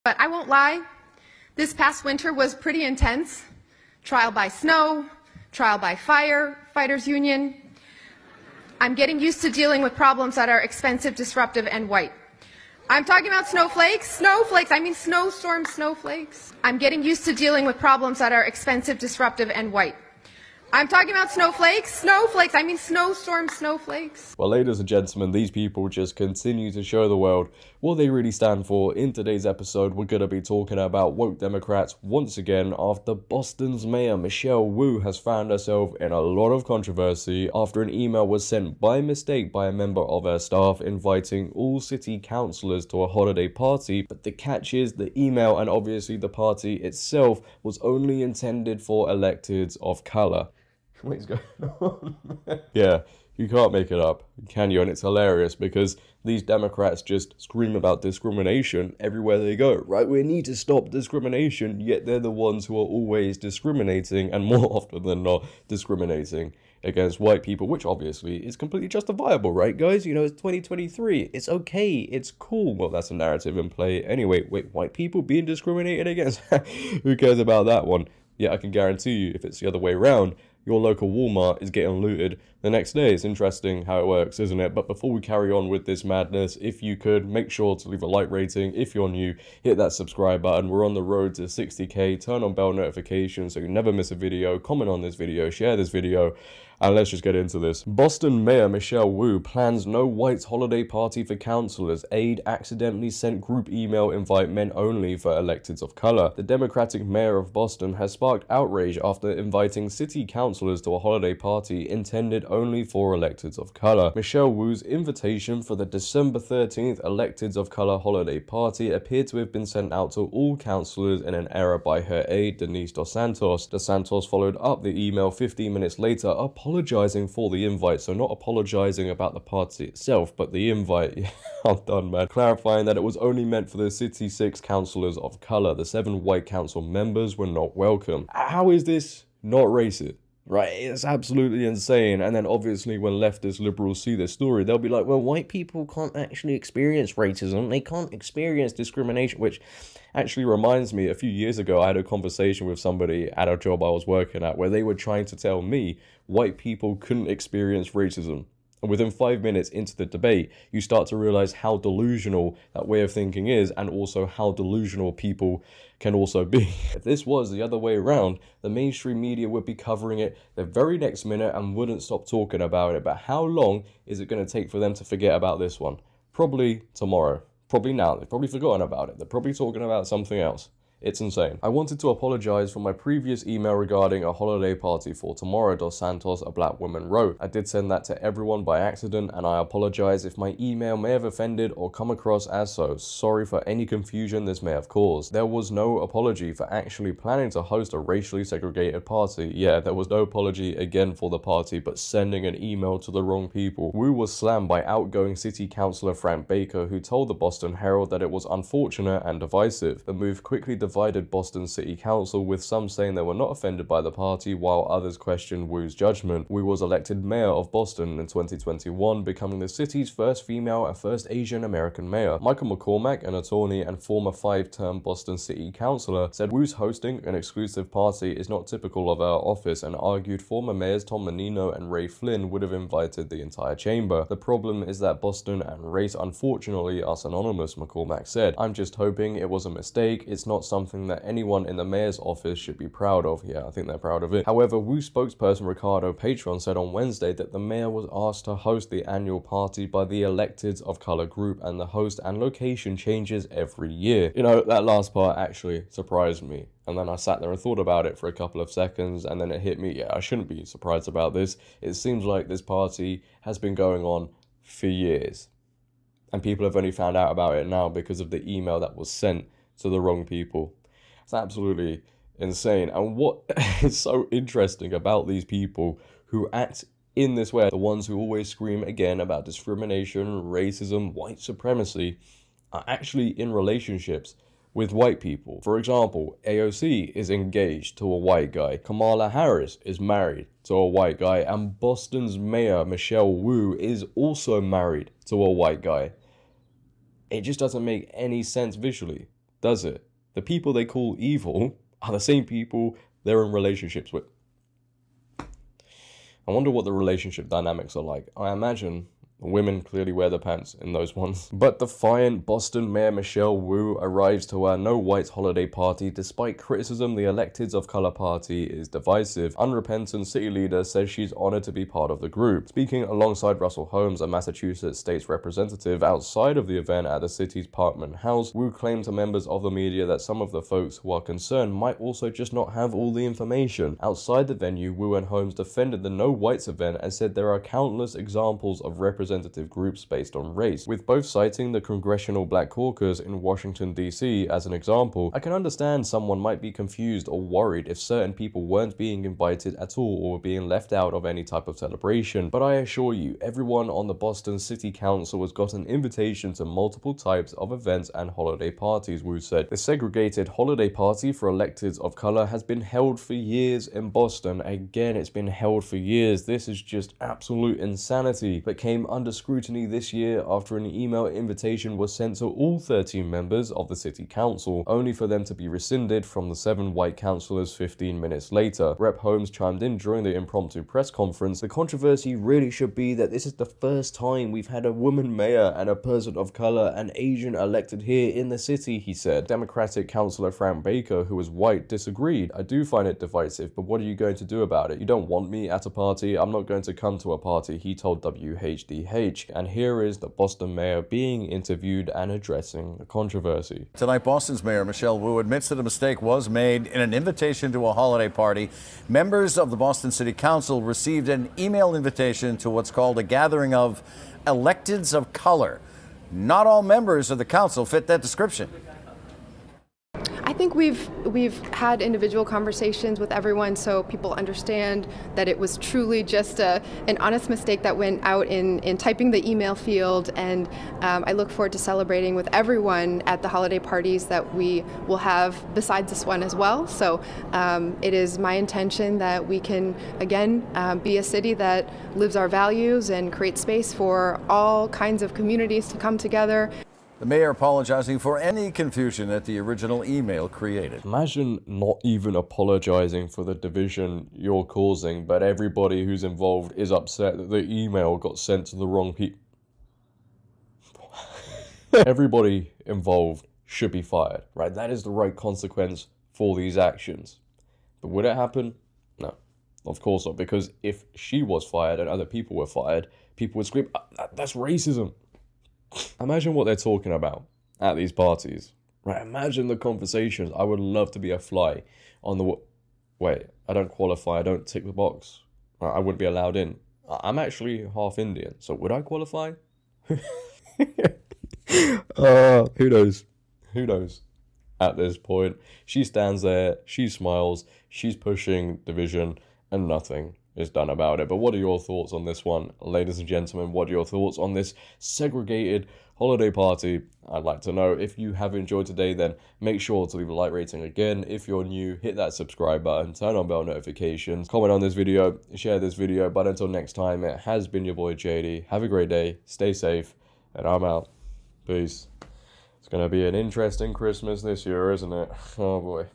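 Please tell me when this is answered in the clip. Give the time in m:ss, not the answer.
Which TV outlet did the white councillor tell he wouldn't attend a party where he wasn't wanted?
6:38.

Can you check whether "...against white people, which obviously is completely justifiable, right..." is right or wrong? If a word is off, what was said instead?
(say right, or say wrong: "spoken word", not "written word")
right.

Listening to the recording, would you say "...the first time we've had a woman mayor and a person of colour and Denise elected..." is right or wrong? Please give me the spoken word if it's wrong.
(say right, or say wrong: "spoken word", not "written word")
wrong: "Asian", not "Denise".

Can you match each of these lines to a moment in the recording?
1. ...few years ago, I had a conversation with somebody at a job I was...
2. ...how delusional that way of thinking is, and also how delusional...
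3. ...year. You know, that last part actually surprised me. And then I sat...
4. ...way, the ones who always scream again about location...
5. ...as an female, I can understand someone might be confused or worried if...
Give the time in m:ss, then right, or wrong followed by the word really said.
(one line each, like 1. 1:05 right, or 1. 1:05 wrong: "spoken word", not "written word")
1. 2:31 right
2. 2:41 right
3. 4:13 right
4. 4:37 wrong: "discrimination", not "location"
5. 5:44 wrong: "example", not "female".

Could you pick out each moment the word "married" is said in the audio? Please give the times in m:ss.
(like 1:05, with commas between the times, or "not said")
4:49, 4:54.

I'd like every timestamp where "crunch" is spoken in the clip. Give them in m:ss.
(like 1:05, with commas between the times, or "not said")
not said.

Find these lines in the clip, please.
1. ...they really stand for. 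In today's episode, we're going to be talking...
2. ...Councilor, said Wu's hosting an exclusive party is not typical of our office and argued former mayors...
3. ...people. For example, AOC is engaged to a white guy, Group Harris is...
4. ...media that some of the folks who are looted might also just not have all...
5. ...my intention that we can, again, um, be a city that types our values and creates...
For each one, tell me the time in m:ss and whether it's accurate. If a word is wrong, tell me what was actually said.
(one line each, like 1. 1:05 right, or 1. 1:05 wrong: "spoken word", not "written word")
1. 0:27 right
2. 3:45 right
3. 4:45 wrong: "Kamala", not "Group"
4. 5:29 wrong: "concerned", not "looted"
5. 7:18 wrong: "lives", not "types".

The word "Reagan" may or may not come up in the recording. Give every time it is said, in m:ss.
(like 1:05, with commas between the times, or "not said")
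not said.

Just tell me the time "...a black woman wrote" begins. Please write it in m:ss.
3:06.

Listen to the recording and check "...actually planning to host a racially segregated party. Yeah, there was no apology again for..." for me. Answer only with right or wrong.
right.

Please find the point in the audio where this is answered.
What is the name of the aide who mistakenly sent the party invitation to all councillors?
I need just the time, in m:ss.
2:02.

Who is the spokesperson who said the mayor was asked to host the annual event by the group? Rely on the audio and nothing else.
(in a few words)
Ricardo Patron.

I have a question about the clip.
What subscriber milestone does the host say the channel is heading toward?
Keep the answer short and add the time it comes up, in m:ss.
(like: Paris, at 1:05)
60k, at 1:31.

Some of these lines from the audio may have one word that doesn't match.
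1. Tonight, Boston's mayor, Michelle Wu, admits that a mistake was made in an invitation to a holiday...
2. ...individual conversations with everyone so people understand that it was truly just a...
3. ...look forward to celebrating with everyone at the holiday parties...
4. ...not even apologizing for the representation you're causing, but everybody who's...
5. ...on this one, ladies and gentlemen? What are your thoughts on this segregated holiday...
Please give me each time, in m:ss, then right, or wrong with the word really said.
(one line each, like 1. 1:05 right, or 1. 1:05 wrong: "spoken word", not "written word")
1. 6:43 right
2. 7:02 right
3. 7:11 right
4. 7:31 wrong: "division", not "representation"
5. 8:22 right.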